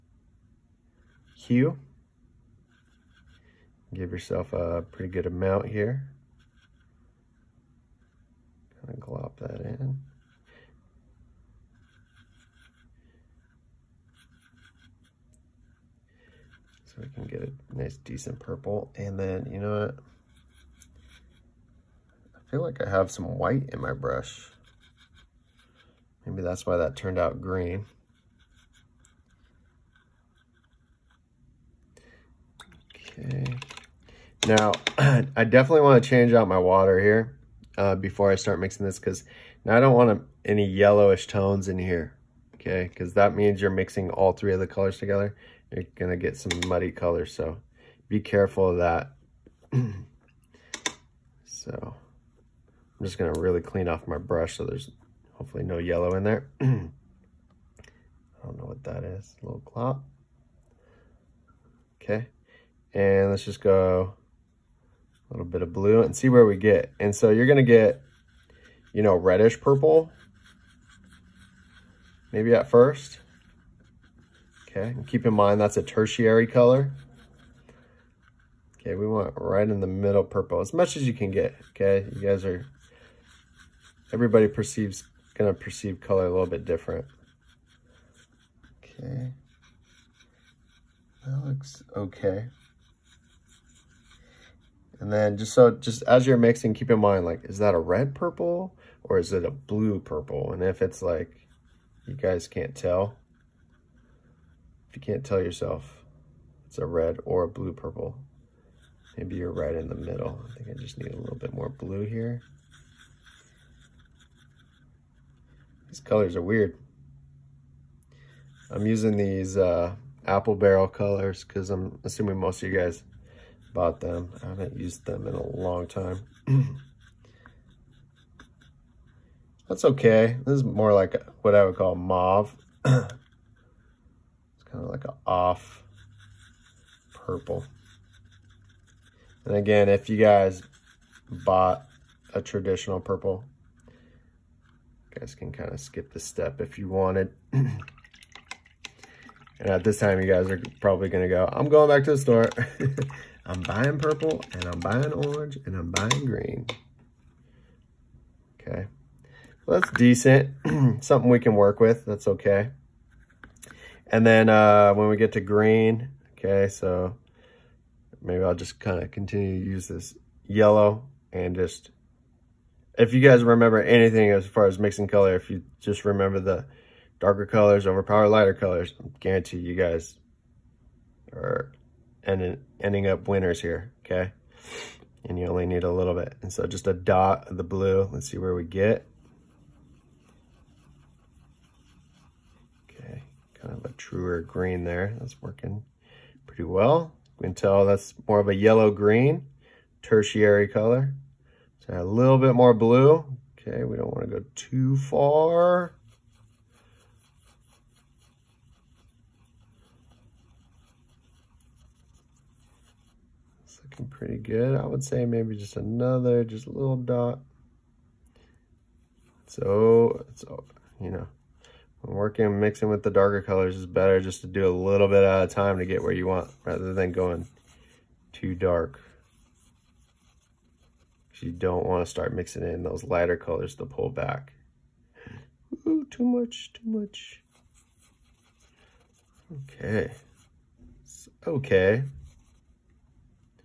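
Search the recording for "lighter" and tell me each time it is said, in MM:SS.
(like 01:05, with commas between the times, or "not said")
02:58, 03:53.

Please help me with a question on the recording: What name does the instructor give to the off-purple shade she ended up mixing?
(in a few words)
Mauve.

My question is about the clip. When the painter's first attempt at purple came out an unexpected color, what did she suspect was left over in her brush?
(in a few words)
White.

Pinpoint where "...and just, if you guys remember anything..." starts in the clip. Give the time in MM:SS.
02:51.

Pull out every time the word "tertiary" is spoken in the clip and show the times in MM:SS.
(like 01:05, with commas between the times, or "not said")
01:15, 03:20.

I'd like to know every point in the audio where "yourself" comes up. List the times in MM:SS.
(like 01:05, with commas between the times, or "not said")
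00:04, 01:45.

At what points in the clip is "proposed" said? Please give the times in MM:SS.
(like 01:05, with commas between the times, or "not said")
not said.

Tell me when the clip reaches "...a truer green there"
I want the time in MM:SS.
03:13.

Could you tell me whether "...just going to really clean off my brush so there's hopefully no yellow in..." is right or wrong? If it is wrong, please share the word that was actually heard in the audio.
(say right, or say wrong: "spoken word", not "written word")
right.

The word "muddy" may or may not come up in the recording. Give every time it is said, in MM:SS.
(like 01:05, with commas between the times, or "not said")
00:46.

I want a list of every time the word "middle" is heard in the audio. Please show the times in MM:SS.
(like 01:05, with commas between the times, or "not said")
01:19, 01:49.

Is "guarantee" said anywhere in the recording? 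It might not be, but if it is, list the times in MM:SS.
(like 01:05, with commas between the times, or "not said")
02:59.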